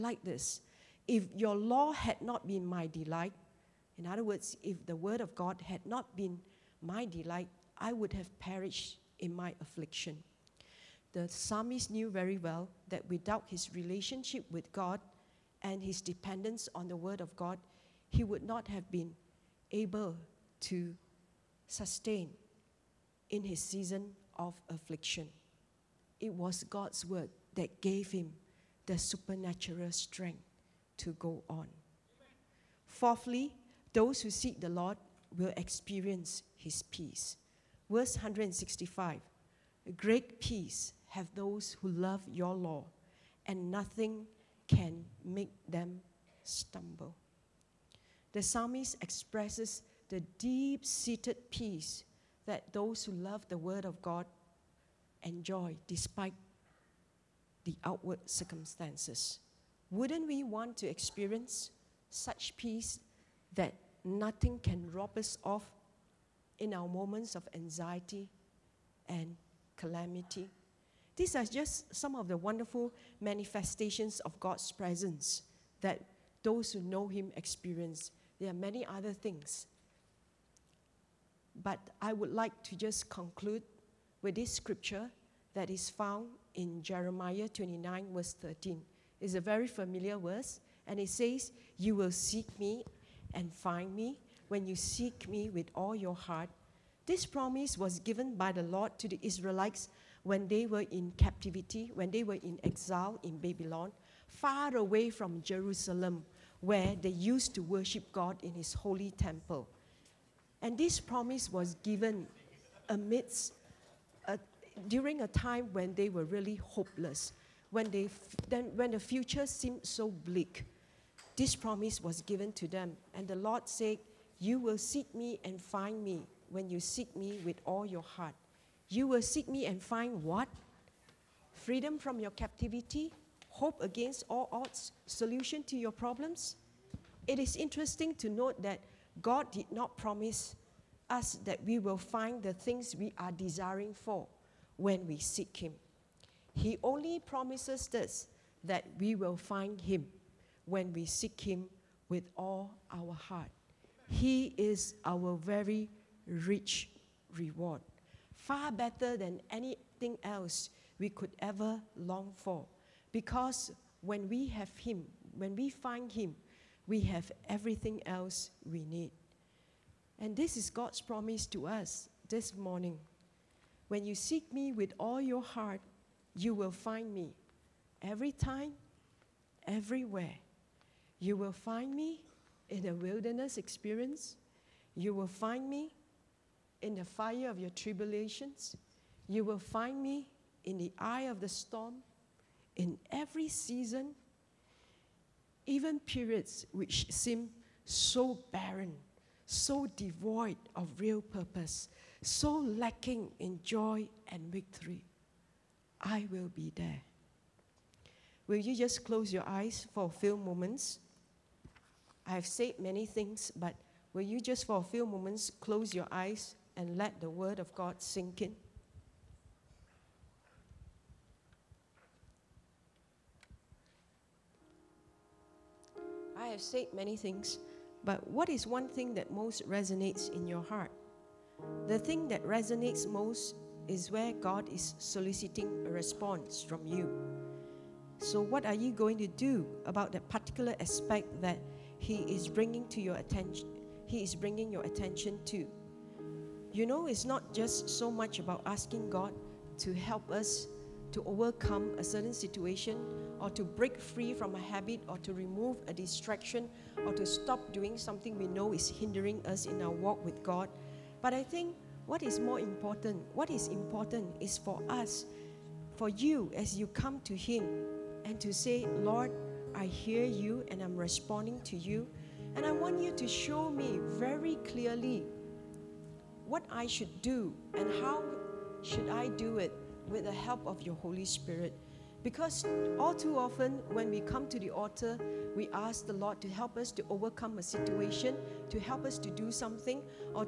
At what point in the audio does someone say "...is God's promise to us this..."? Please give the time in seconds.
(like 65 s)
170 s.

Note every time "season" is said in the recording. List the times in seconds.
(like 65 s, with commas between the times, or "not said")
23 s, 193 s.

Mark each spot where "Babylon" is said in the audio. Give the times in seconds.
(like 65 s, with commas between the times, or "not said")
103 s.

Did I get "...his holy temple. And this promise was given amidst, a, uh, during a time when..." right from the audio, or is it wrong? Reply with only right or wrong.
right.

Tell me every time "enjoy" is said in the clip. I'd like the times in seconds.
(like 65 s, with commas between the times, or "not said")
55 s.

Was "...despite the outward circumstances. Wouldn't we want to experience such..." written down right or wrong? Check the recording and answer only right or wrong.
right.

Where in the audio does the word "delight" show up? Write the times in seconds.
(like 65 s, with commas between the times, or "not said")
2 s, 7 s.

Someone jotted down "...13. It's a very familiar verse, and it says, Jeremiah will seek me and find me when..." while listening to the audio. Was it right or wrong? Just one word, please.
wrong.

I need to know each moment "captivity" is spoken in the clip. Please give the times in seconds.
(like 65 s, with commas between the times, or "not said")
101 s, 132 s.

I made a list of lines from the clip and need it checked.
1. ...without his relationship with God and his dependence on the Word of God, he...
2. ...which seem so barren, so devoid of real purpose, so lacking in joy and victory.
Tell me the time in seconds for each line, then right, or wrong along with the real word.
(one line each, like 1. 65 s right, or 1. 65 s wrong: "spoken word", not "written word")
1. 13 s right
2. 196 s right.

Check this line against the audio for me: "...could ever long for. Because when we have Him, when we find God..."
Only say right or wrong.
wrong.